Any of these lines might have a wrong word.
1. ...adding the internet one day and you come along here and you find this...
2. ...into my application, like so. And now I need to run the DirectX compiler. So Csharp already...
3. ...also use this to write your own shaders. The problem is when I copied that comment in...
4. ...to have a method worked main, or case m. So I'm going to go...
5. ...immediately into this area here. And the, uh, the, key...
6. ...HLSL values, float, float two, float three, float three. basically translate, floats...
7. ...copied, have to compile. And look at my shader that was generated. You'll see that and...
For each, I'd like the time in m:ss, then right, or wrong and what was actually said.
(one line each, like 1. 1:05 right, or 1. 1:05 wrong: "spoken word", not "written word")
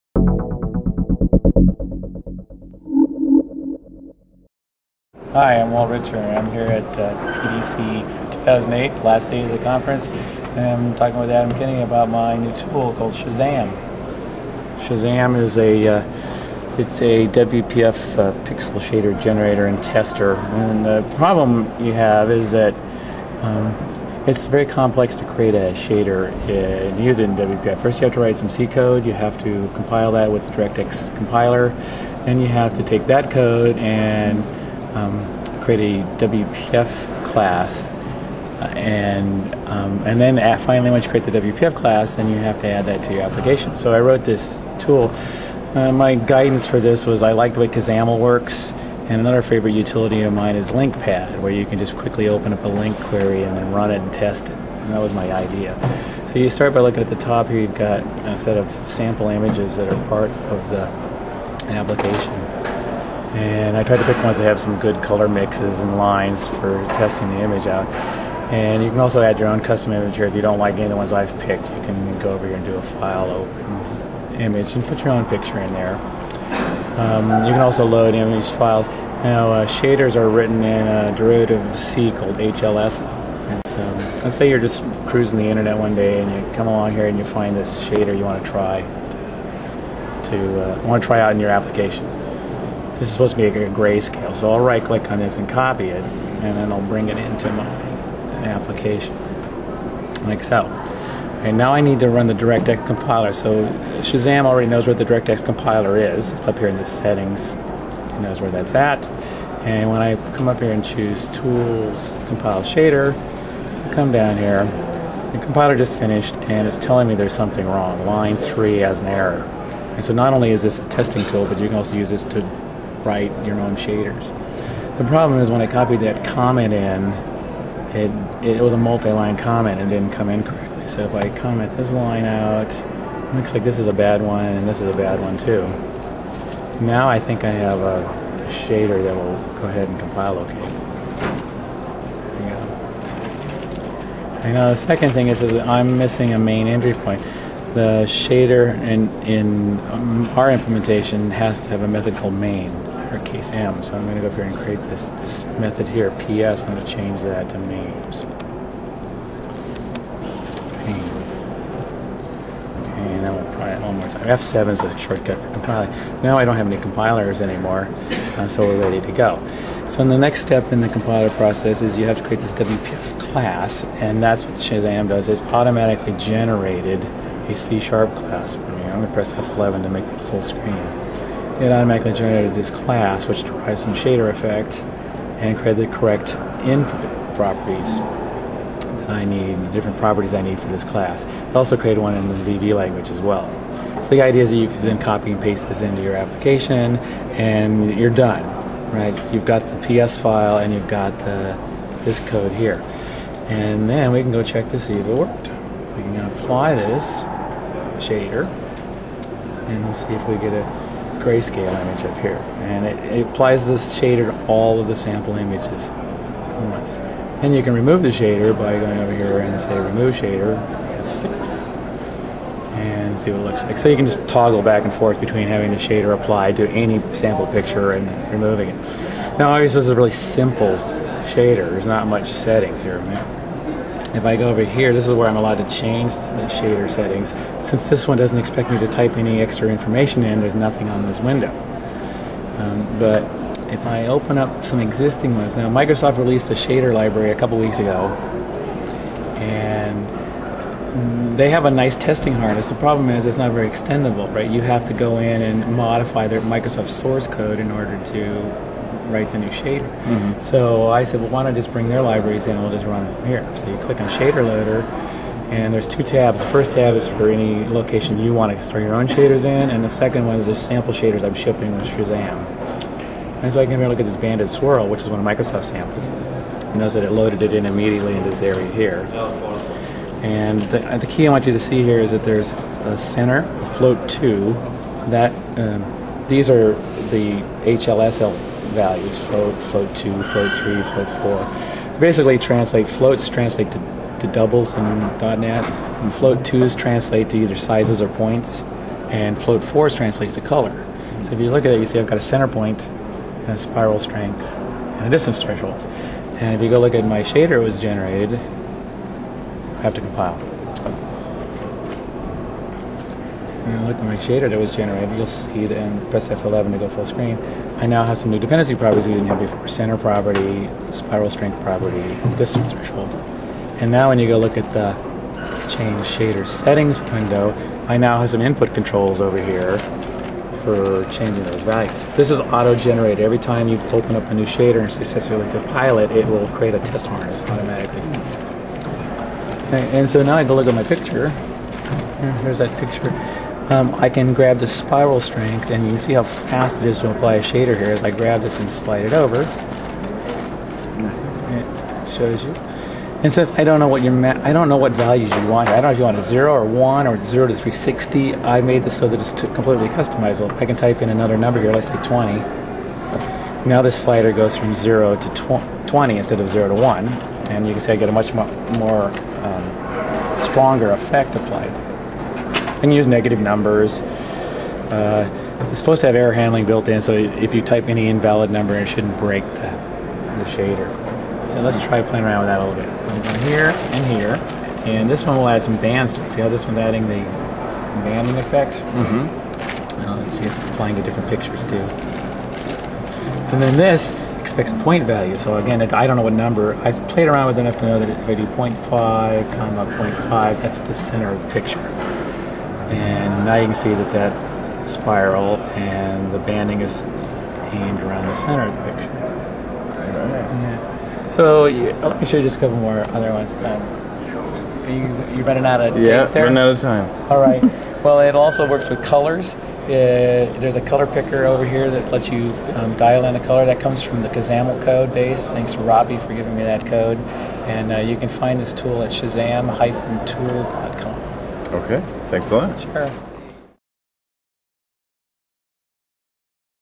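1. 1:25 wrong: "cruising", not "adding"
2. 1:37 wrong: "Shazzam", not "Csharp"
3. 2:01 right
4. 2:31 wrong: "called", not "worked"
5. 4:37 right
6. 4:47 wrong: "four", not "three"
7. 5:07 wrong: "generated", not "copied".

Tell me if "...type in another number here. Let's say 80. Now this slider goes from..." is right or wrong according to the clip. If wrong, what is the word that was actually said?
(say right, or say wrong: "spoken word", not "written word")
wrong: "20", not "80".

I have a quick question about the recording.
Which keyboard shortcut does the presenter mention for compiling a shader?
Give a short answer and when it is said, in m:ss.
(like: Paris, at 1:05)
F7, at 2:44.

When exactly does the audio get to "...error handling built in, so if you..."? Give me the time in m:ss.
6:16.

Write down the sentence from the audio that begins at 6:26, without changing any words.
See how this one's adding the banding effect?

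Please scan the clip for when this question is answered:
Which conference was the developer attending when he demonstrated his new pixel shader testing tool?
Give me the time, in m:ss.
0:07.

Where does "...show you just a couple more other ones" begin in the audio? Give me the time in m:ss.
6:52.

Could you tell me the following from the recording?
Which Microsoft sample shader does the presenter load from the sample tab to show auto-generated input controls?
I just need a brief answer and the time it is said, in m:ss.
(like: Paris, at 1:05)
banded swirl, at 4:34.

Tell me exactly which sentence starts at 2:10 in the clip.
So if I comment this line out, looks like this is a bad one and this is a bad one too.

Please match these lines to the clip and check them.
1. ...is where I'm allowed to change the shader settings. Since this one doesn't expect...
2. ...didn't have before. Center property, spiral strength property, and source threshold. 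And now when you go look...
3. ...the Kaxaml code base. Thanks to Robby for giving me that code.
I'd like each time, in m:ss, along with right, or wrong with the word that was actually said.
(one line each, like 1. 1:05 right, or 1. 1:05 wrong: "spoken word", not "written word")
1. 3:55 right
2. 5:19 wrong: "distance", not "source"
3. 7:04 right.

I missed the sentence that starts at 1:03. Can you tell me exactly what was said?
And I tried to pick ones that have some good color mixes and lines for testing the image out.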